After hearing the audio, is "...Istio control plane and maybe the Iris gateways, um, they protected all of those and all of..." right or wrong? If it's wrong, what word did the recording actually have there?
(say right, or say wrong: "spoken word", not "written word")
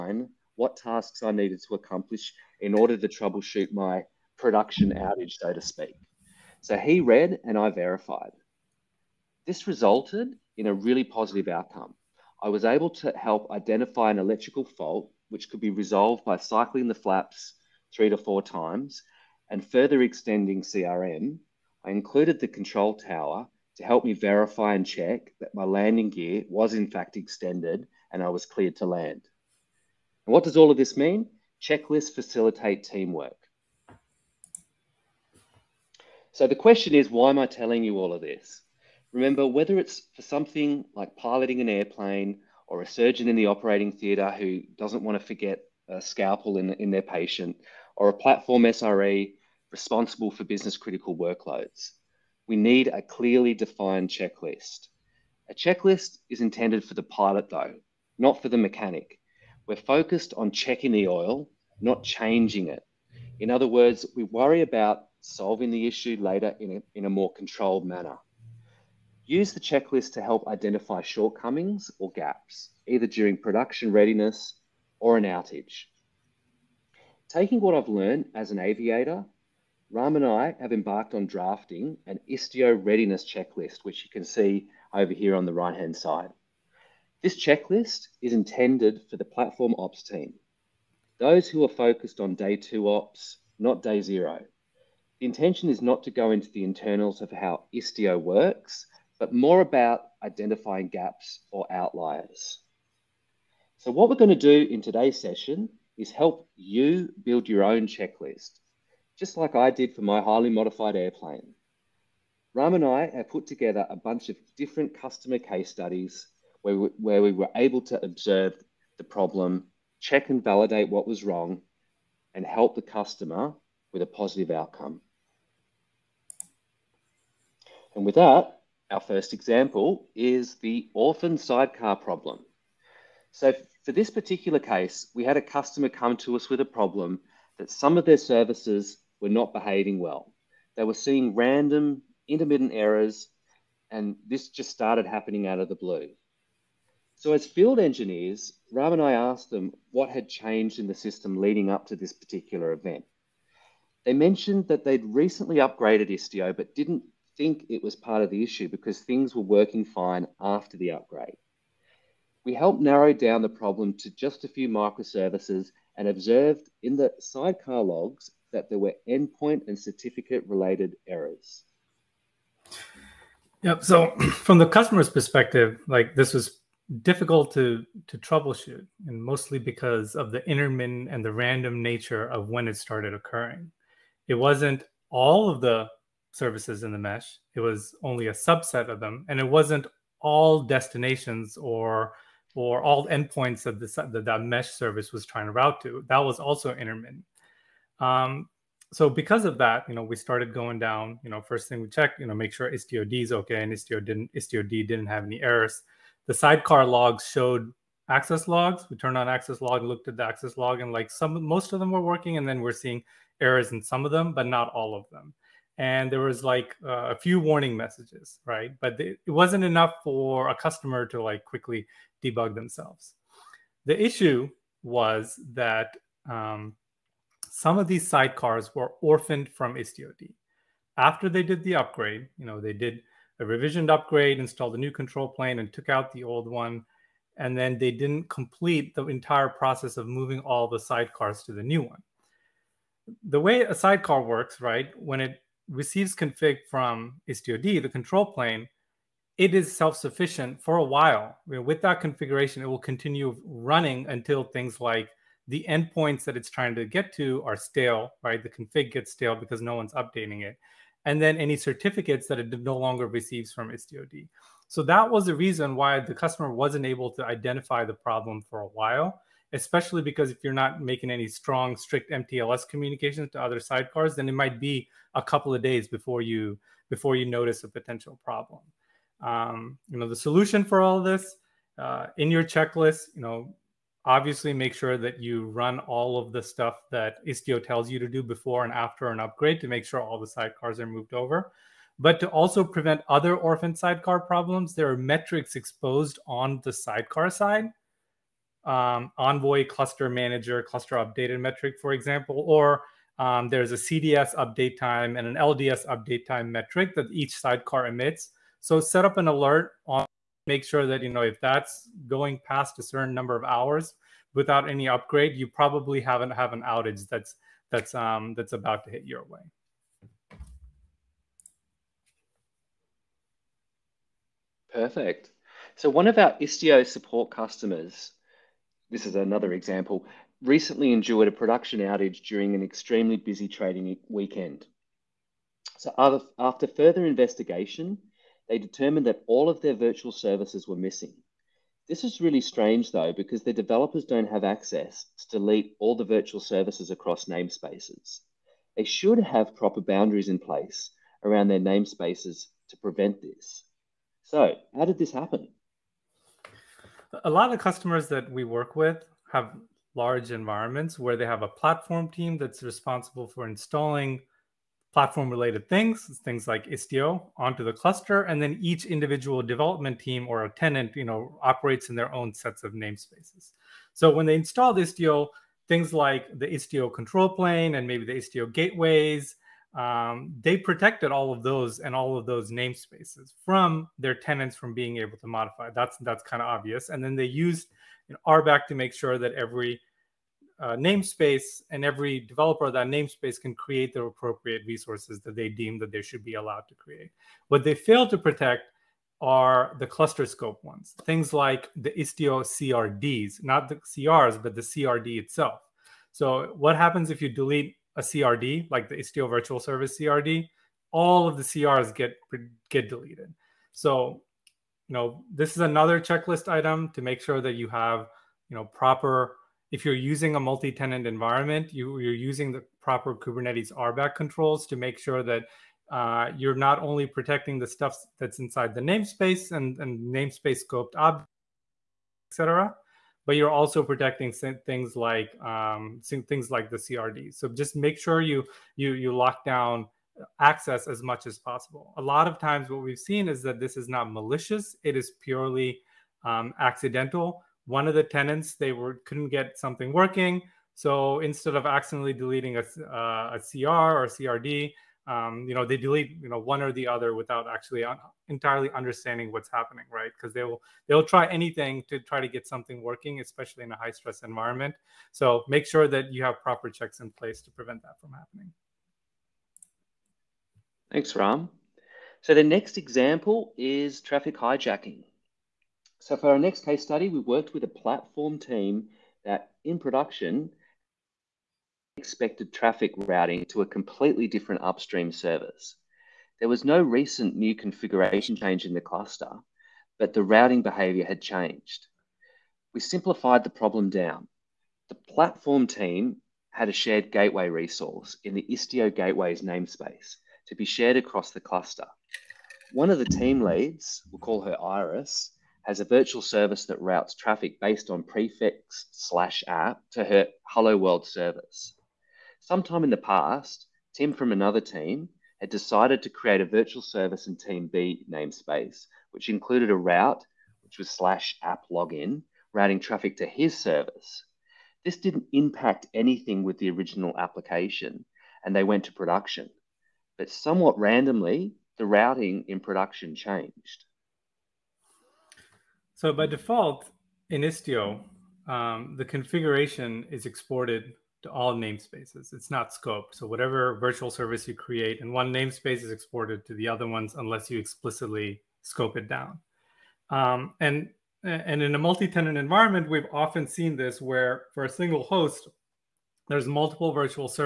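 wrong: "Istio", not "Iris".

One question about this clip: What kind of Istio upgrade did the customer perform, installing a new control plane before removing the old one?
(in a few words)
revisioned upgrade.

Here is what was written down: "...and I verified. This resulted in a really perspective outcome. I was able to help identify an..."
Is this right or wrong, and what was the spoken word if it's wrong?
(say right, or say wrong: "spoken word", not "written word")
wrong: "positive", not "perspective".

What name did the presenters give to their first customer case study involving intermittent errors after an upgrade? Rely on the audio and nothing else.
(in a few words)
orphan sidecar problem.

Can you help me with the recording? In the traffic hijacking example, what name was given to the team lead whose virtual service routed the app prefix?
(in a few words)
Iris.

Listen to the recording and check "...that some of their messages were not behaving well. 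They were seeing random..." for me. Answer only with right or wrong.
wrong.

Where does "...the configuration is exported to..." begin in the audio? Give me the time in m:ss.
8:58.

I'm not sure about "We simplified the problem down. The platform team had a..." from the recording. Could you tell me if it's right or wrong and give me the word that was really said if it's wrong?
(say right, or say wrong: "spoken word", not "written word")
right.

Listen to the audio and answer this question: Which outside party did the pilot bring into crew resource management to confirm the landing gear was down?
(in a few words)
the control tower.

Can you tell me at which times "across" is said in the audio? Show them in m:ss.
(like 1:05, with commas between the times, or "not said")
5:46, 8:20.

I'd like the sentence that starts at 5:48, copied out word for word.
They should have proper boundaries in place around their namespaces to prevent this.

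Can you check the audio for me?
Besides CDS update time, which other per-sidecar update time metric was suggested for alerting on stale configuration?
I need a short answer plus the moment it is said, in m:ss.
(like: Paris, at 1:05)
LDS update time, at 5:05.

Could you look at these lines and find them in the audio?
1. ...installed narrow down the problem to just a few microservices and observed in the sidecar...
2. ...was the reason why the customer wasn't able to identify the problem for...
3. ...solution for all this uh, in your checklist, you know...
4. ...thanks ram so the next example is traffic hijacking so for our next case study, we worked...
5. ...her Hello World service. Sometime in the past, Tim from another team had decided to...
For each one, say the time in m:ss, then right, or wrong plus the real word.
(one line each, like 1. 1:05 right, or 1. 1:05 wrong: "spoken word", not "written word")
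1. 2:42 wrong: "helped", not "installed"
2. 4:25 right
3. 4:40 right
4. 7:50 right
5. 8:30 right.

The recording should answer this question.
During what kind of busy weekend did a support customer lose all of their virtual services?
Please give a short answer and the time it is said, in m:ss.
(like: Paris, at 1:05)
trading weekend, at 5:33.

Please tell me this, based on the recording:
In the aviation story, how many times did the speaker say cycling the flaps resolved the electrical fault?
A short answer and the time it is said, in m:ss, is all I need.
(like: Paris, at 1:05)
3 to 4, at 0:17.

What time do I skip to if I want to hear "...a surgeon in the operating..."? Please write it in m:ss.
0:42.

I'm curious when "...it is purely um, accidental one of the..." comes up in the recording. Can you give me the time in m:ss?
7:24.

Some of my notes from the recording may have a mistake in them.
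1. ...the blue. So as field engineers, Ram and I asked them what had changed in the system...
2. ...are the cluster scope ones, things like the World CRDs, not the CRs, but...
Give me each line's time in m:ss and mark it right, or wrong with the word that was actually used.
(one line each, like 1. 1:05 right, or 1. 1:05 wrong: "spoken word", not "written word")
1. 2:25 right
2. 6:39 wrong: "Istio", not "World".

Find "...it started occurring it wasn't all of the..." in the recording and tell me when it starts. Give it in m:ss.
3:02.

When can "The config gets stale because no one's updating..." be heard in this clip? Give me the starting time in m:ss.
4:18.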